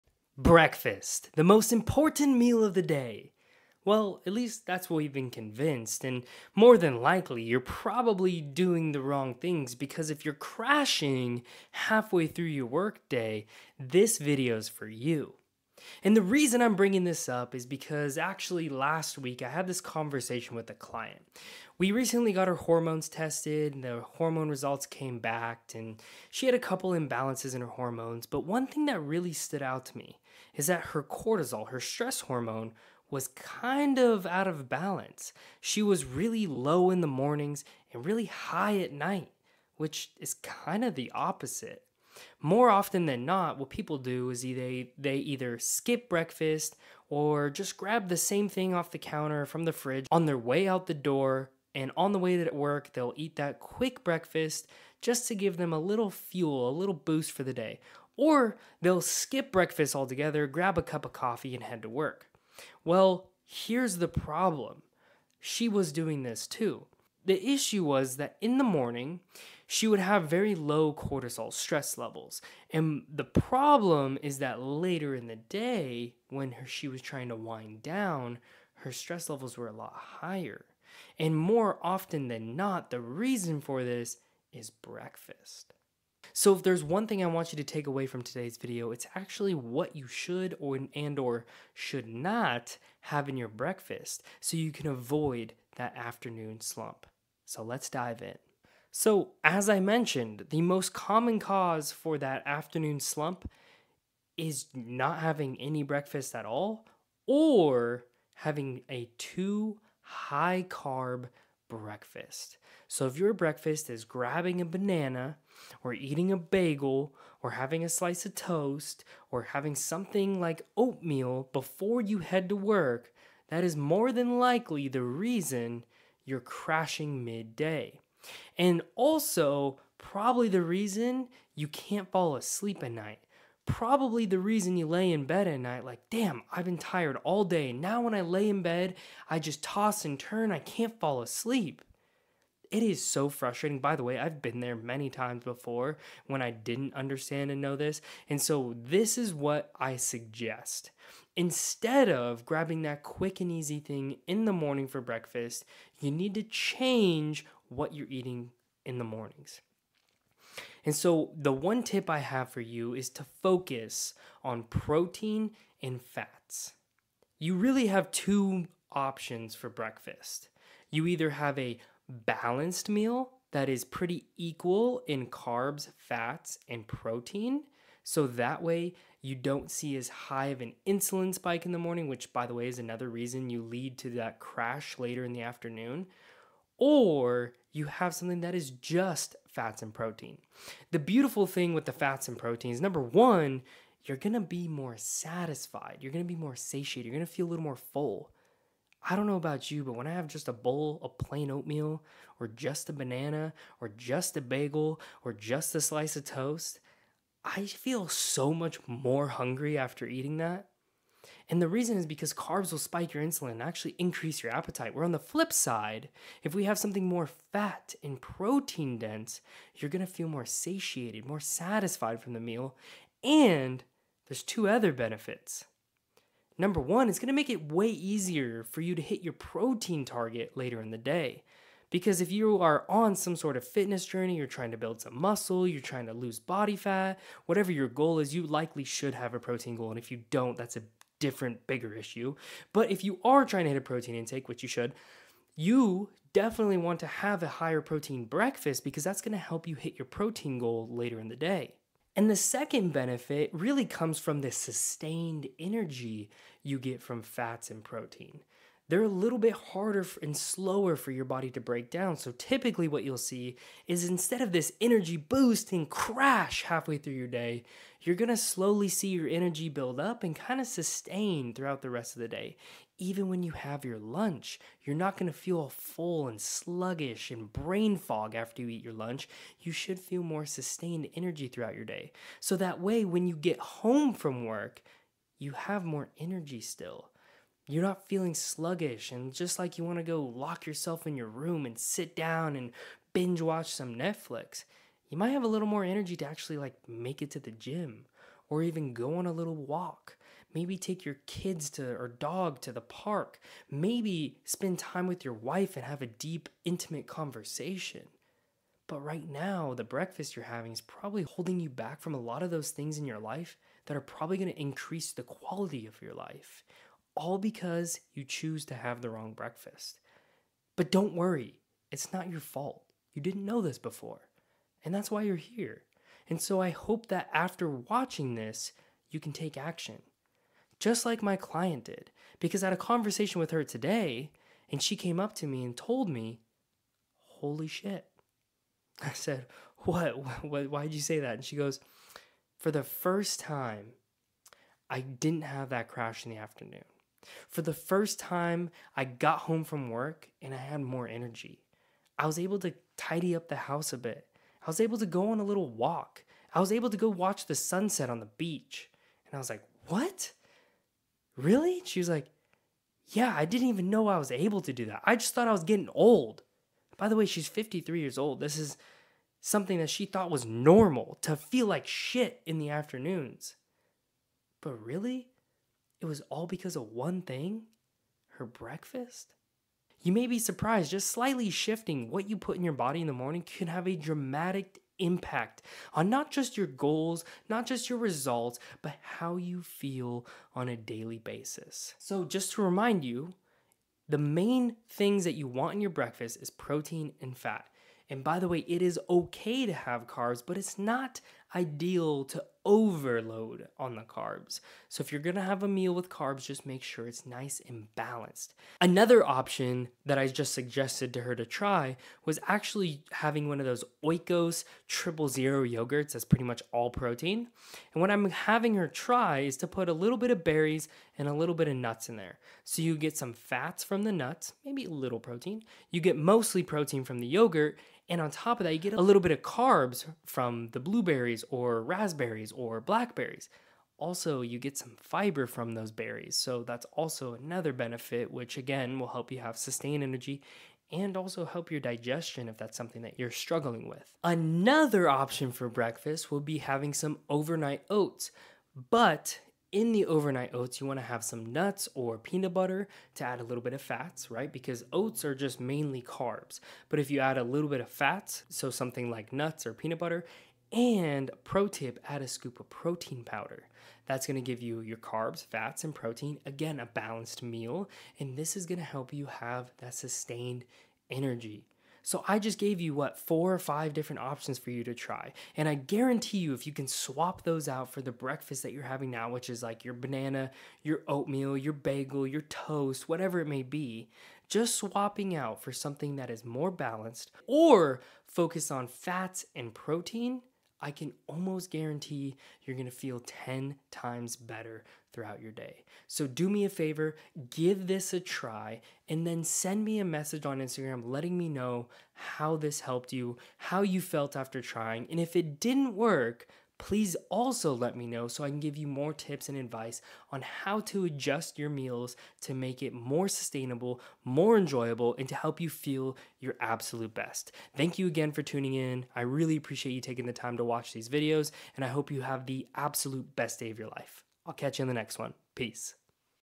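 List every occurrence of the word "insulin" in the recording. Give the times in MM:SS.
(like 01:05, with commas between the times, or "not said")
03:00, 03:33.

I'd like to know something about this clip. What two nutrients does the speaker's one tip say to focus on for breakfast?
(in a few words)
Protein and fats.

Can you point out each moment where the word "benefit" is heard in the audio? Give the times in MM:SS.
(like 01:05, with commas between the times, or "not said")
03:44, 04:12, 07:17.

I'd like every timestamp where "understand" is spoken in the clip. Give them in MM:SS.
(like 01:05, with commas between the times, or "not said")
02:26.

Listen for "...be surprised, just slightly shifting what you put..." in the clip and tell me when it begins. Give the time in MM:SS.
06:20.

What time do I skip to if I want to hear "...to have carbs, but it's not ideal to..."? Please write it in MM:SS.
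06:39.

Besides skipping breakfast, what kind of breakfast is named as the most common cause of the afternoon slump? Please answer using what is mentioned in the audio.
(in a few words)
Too high carb.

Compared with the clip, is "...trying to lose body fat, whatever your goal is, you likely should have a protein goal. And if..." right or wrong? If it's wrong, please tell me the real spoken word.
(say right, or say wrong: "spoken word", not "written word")
right.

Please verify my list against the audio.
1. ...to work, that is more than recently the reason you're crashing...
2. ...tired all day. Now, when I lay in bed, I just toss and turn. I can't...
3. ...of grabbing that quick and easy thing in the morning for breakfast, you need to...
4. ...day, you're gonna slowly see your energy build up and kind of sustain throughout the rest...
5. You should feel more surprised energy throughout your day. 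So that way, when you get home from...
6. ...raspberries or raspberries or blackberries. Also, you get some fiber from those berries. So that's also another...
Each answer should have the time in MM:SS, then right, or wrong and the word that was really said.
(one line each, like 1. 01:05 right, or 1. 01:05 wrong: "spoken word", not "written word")
1. 02:02 wrong: "likely", not "recently"
2. 02:16 right
3. 02:32 right
4. 04:27 right
5. 04:39 wrong: "sustained", not "surprised"
6. 07:10 wrong: "blueberries", not "raspberries".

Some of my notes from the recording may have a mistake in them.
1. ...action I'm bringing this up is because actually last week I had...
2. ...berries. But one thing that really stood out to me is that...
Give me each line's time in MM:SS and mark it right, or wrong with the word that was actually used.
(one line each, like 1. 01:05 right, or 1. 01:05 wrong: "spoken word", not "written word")
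1. 00:16 wrong: "reason", not "action"
2. 00:27 wrong: "hormones", not "berries".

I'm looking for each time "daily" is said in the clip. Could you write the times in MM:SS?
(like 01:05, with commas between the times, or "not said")
06:30.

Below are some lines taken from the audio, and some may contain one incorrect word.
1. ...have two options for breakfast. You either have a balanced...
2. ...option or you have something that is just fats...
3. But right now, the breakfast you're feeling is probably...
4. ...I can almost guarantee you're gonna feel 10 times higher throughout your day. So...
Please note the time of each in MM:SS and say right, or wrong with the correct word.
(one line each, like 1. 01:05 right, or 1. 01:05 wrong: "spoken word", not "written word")
1. 02:47 right
2. 03:05 wrong: "afternoon", not "option"
3. 05:08 wrong: "having", not "feeling"
4. 08:10 wrong: "better", not "higher".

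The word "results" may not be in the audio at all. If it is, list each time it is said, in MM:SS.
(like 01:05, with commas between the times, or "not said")
00:24, 06:27.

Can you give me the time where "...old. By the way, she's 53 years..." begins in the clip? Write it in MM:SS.
06:05.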